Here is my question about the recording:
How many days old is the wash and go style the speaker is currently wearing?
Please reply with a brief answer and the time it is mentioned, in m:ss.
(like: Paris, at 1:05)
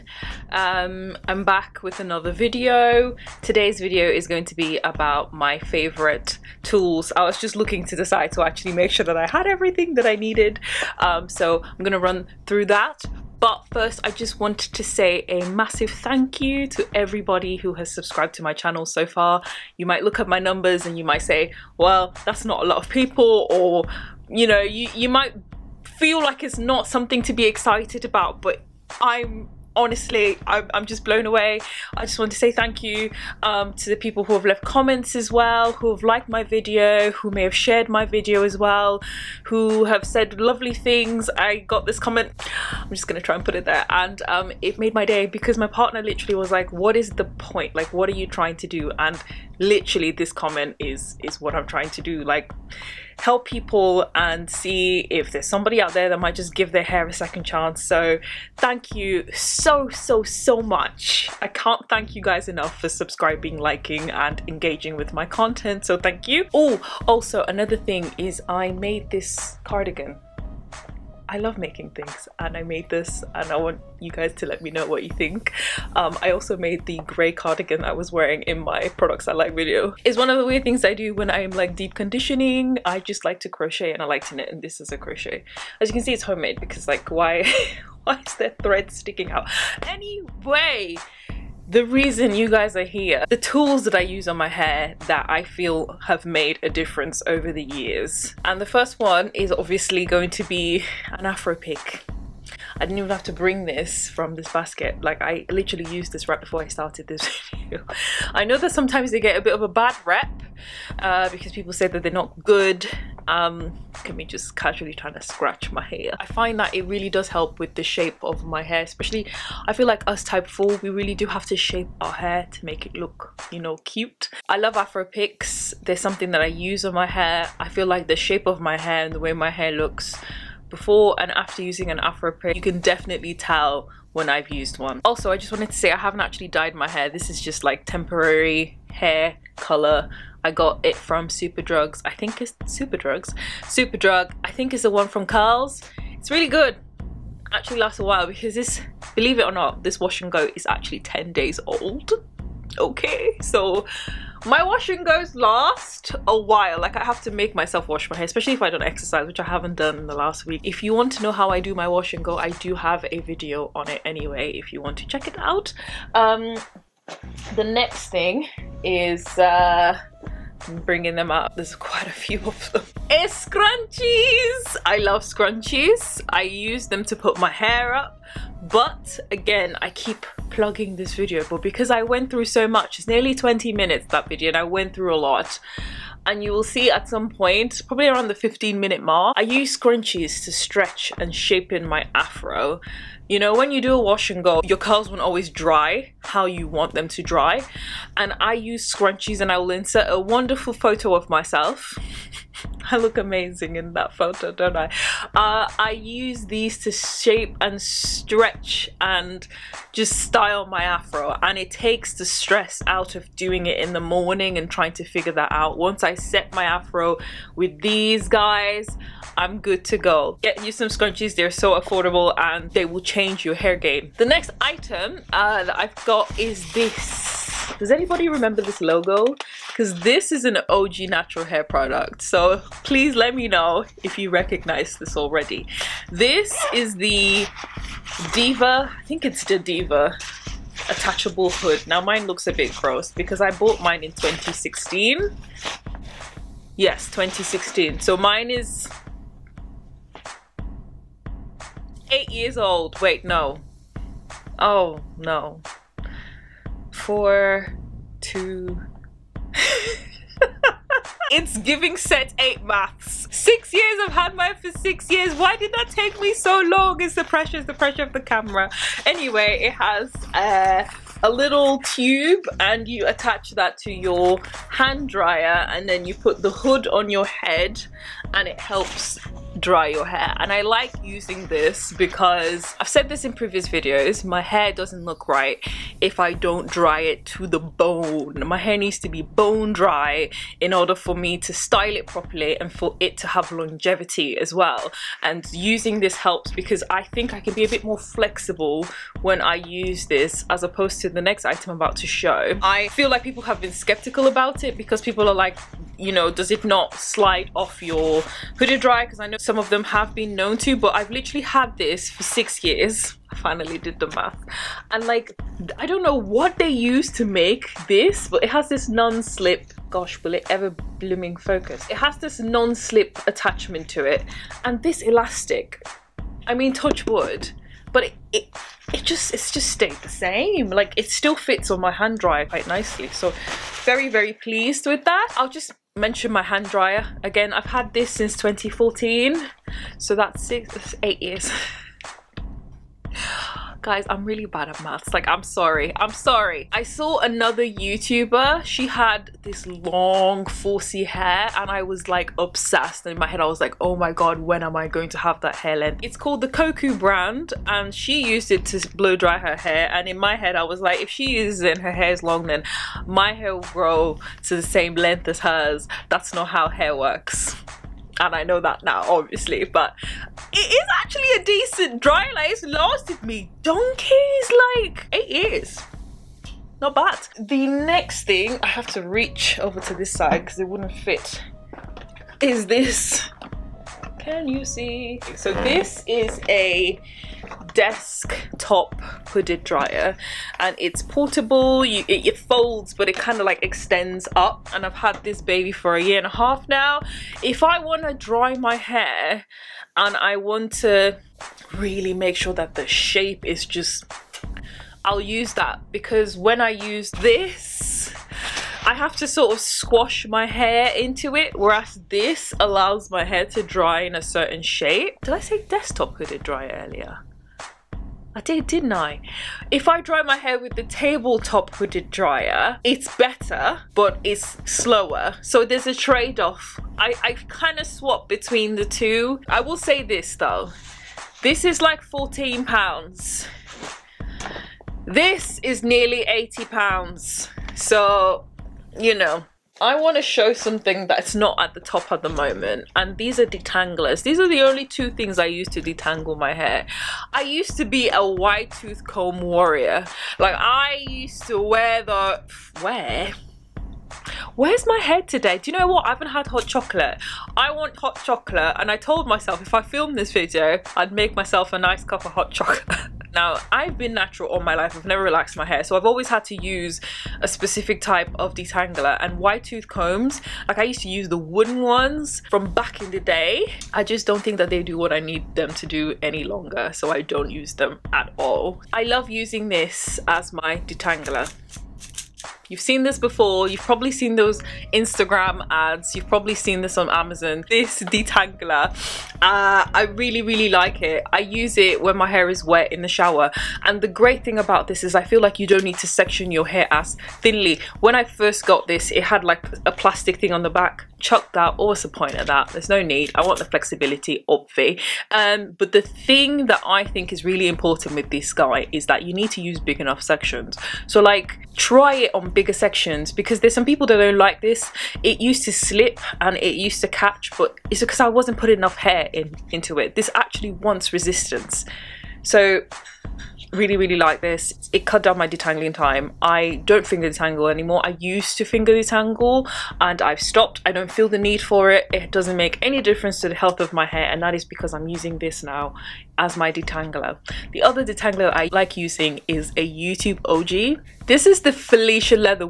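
10 days, at 2:30.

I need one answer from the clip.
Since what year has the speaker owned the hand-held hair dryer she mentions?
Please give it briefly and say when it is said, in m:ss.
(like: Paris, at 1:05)
2014, at 5:37.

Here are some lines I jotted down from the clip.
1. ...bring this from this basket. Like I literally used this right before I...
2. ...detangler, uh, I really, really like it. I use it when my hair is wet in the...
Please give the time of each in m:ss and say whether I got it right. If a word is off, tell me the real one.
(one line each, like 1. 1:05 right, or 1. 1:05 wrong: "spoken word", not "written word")
1. 1:43 right
2. 8:08 right.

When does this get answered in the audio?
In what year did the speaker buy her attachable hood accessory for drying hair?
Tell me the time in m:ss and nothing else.
4:03.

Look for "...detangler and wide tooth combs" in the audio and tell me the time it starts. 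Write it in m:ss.
7:48.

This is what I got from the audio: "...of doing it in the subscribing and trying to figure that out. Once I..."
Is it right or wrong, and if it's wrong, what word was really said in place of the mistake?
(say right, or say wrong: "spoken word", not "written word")
wrong: "morning", not "subscribing".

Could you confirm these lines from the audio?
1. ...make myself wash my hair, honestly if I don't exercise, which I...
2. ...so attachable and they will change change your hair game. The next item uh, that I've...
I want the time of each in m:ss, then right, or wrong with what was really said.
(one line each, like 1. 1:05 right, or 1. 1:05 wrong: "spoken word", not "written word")
1. 2:37 wrong: "especially", not "honestly"
2. 3:41 wrong: "affordable", not "attachable".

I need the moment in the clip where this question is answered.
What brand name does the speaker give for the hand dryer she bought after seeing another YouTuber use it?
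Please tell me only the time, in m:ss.
5:56.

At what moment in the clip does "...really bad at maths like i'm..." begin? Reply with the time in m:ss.
5:44.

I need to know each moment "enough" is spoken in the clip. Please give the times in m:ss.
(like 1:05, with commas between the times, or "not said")
1:02, 8:29, 8:38.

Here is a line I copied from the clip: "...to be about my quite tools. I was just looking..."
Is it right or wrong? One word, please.
wrong.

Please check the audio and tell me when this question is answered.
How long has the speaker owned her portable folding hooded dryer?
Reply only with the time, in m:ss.
6:35.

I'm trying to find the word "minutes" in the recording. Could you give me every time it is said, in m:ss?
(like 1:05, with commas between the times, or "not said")
3:03, 3:08.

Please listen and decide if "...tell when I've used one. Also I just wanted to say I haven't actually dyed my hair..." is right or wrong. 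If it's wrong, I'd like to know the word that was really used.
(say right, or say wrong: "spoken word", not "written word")
right.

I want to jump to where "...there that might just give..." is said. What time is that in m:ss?
0:55.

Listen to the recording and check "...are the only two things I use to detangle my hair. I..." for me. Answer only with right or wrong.
right.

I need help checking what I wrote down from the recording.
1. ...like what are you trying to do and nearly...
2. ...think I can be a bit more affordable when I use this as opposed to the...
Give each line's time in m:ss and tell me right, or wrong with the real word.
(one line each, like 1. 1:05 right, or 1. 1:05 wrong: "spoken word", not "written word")
1. 0:47 wrong: "literally", not "nearly"
2. 4:57 wrong: "flexible", not "affordable".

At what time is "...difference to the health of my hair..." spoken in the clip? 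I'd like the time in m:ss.
8:53.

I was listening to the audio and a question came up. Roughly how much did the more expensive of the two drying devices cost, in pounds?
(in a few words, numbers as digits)
80 pounds.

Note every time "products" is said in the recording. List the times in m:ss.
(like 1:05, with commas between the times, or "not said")
1:18, 3:51.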